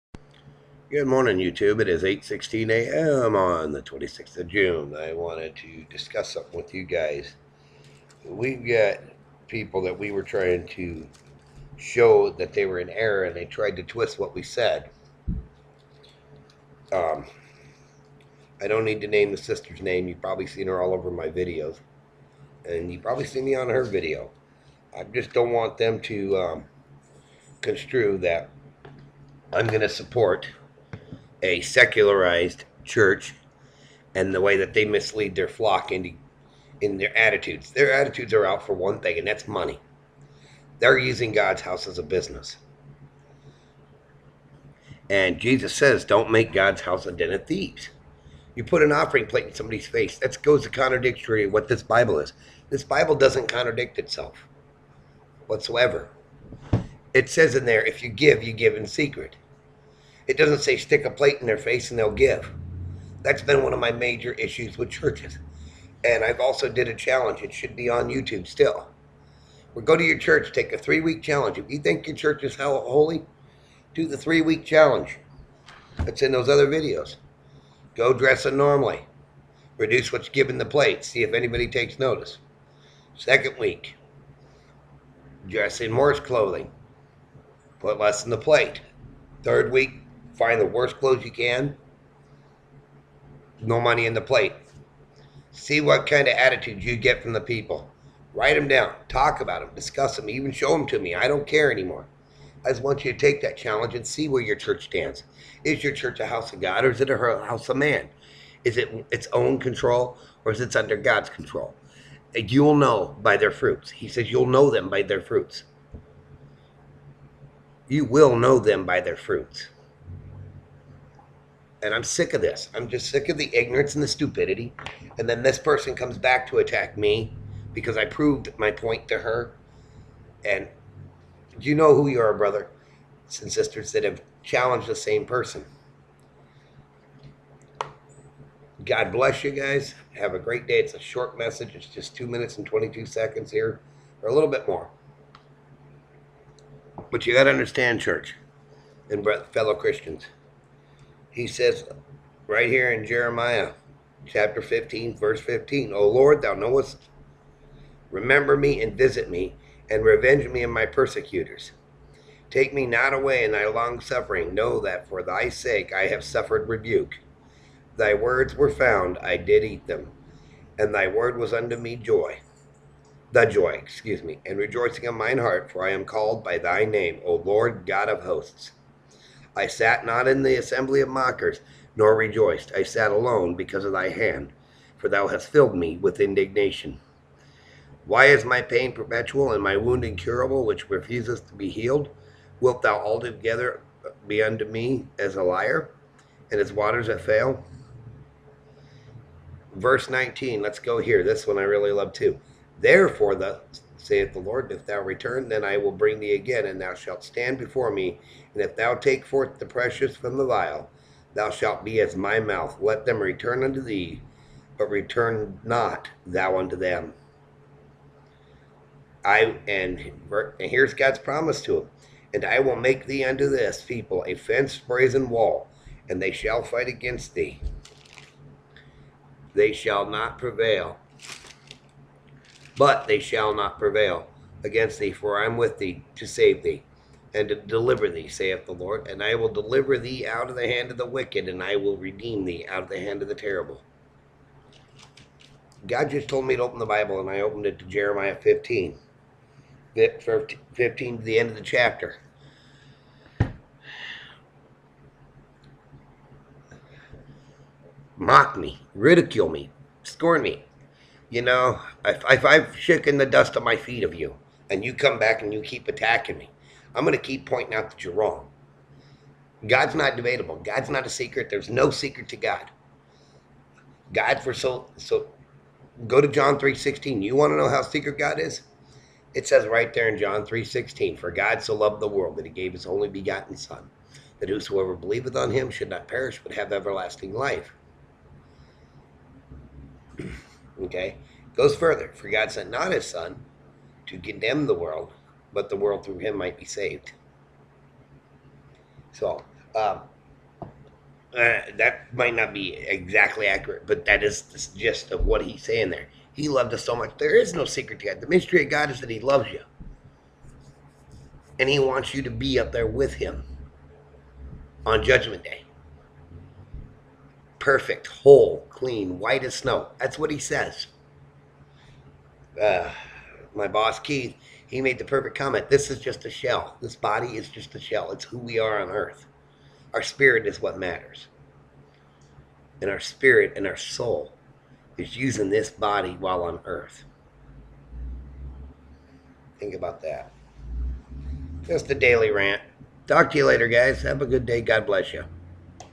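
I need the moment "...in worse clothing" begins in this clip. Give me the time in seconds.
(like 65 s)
85 s.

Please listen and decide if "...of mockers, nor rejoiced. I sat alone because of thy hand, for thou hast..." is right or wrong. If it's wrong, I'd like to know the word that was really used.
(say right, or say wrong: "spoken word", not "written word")
right.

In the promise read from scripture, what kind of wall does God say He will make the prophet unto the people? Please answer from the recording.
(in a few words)
fenced brazen wall.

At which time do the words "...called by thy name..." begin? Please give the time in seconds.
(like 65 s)
176 s.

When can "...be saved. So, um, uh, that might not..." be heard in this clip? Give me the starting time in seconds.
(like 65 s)
296 s.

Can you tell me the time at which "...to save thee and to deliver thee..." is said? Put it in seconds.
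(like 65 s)
236 s.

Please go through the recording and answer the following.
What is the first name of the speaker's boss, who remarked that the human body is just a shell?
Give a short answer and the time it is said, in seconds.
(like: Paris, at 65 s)
Keith, at 323 s.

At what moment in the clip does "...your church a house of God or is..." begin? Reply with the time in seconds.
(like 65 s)
105 s.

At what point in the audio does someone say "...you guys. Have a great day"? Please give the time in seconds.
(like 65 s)
139 s.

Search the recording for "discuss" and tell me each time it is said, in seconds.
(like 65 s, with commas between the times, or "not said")
5 s, 99 s.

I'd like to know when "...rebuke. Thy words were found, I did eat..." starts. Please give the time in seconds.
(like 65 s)
166 s.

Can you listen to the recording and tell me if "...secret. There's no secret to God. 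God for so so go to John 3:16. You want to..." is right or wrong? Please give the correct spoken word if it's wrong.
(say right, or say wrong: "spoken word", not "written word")
right.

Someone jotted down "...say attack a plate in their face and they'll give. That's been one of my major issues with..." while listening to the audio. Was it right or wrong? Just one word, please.
wrong.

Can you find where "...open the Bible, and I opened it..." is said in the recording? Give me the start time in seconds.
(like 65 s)
246 s.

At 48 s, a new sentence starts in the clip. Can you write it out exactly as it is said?
You put an offering plate in somebody's face.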